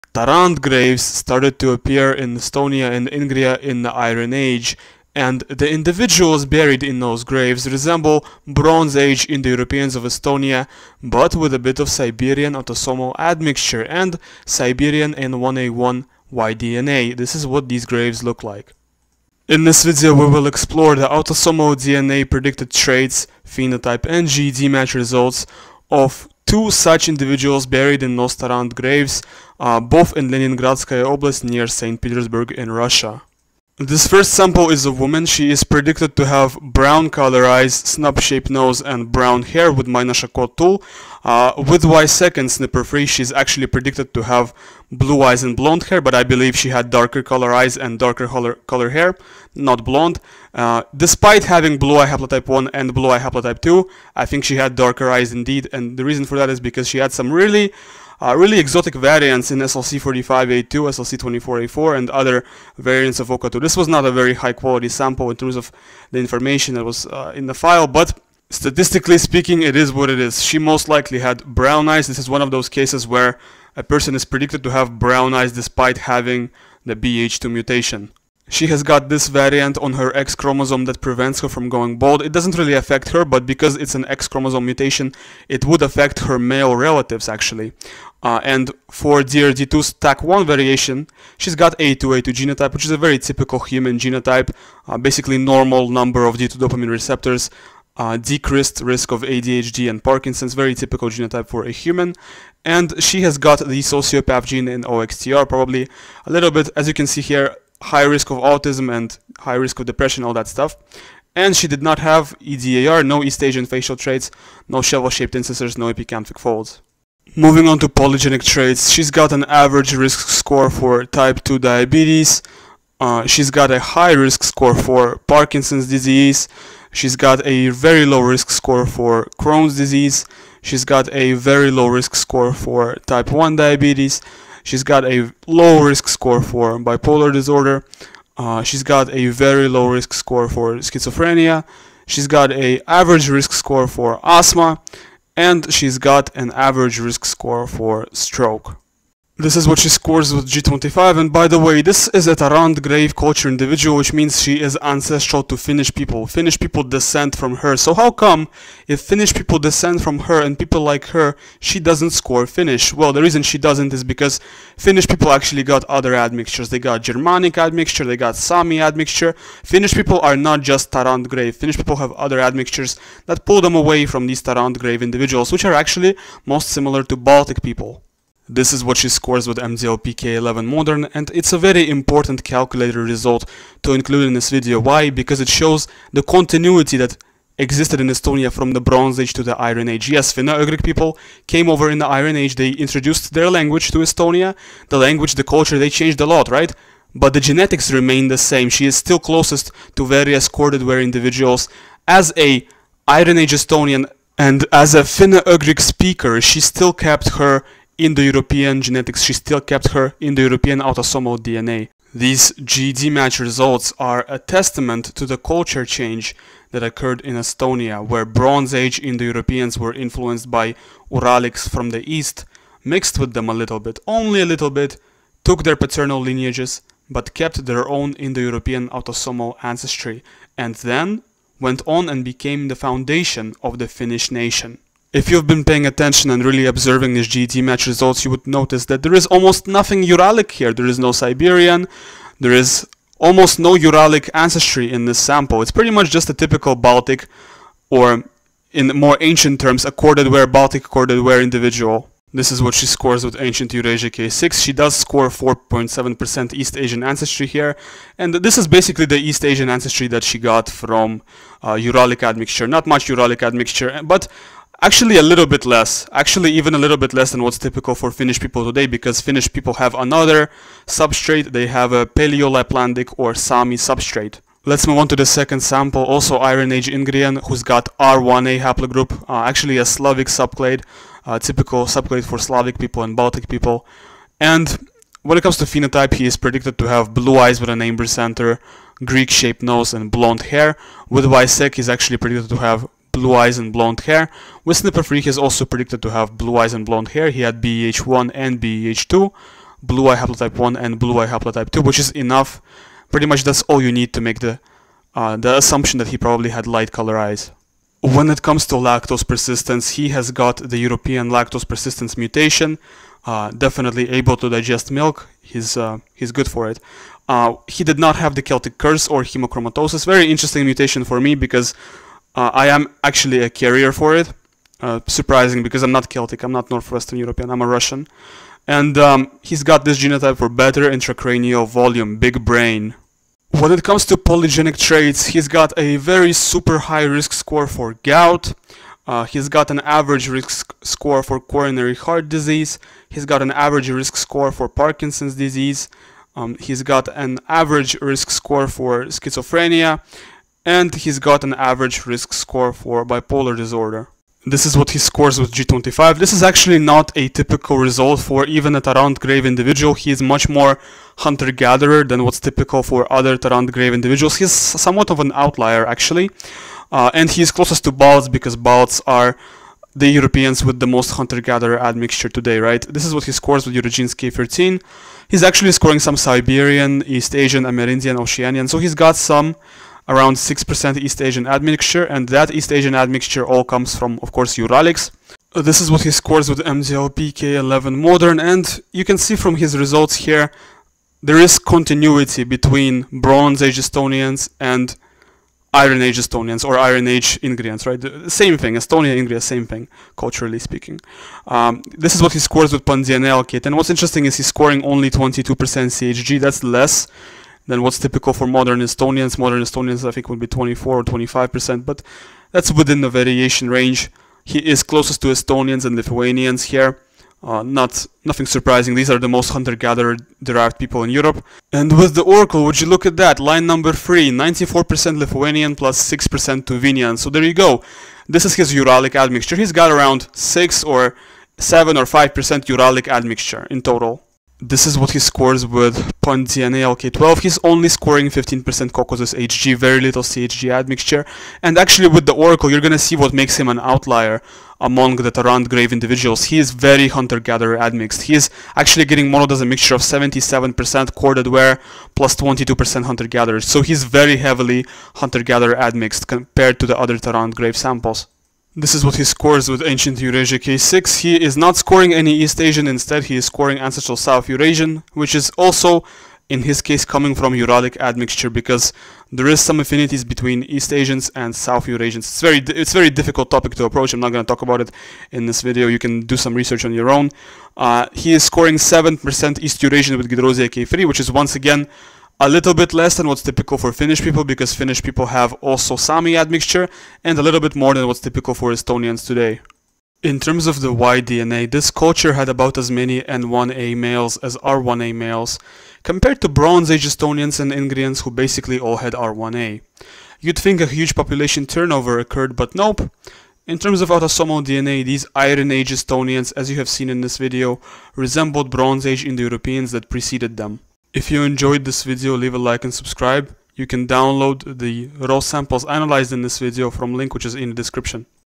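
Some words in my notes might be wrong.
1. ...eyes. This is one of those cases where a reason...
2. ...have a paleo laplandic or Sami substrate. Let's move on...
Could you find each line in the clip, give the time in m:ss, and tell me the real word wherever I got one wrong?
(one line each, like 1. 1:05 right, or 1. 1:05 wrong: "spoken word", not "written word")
1. 1:11 wrong: "person", not "reason"
2. 4:31 right.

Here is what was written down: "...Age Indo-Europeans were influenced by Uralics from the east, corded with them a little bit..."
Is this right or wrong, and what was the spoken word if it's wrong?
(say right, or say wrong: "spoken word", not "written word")
wrong: "mixed", not "corded".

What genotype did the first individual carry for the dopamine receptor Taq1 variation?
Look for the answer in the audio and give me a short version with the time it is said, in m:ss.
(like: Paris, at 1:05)
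A2A2, at 1:31.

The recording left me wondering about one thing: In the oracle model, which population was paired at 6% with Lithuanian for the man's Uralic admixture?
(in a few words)
Tuvinian.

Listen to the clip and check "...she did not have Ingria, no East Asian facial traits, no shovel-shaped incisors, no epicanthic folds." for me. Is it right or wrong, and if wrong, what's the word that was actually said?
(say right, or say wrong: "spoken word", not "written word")
wrong: "EDAR", not "Ingria".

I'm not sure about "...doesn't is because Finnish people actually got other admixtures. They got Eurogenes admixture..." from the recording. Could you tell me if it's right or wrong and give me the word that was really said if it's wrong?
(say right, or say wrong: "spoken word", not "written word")
wrong: "Germanic", not "Eurogenes".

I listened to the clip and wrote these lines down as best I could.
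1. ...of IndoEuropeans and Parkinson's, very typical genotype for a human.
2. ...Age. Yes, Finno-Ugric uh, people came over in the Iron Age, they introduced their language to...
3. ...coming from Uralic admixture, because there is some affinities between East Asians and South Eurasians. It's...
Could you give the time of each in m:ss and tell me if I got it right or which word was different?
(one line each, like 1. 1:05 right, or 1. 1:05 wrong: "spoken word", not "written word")
1. 1:39 wrong: "ADHD", not "IndoEuropeans"
2. 3:09 right
3. 7:47 right.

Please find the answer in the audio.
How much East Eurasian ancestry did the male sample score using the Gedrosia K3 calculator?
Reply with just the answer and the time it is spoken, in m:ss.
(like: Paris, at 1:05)
7%, at 7:58.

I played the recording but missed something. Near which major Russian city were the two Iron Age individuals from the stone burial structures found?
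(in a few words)
St. Petersburg.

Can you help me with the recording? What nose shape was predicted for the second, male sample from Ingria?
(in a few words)
Greek-shaped.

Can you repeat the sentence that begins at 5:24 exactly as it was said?
Uh, surprising because I'm not Celtic, I'm not Northwestern European, I'm a Russian.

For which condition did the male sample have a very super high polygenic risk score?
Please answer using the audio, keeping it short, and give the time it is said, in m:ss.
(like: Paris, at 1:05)
gout, at 5:38.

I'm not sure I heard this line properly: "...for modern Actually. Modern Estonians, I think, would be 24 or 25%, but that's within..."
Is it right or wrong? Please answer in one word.
wrong.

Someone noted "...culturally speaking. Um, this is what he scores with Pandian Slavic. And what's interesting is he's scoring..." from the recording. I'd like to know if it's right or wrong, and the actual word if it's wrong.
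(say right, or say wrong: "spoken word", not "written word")
wrong: "Elkit", not "Slavic".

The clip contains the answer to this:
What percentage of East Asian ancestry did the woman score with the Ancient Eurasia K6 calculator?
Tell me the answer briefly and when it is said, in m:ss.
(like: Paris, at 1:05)
4.7%, at 4:15.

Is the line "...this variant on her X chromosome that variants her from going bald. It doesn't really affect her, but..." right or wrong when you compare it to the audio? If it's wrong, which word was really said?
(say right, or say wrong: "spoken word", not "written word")
wrong: "prevents", not "variants".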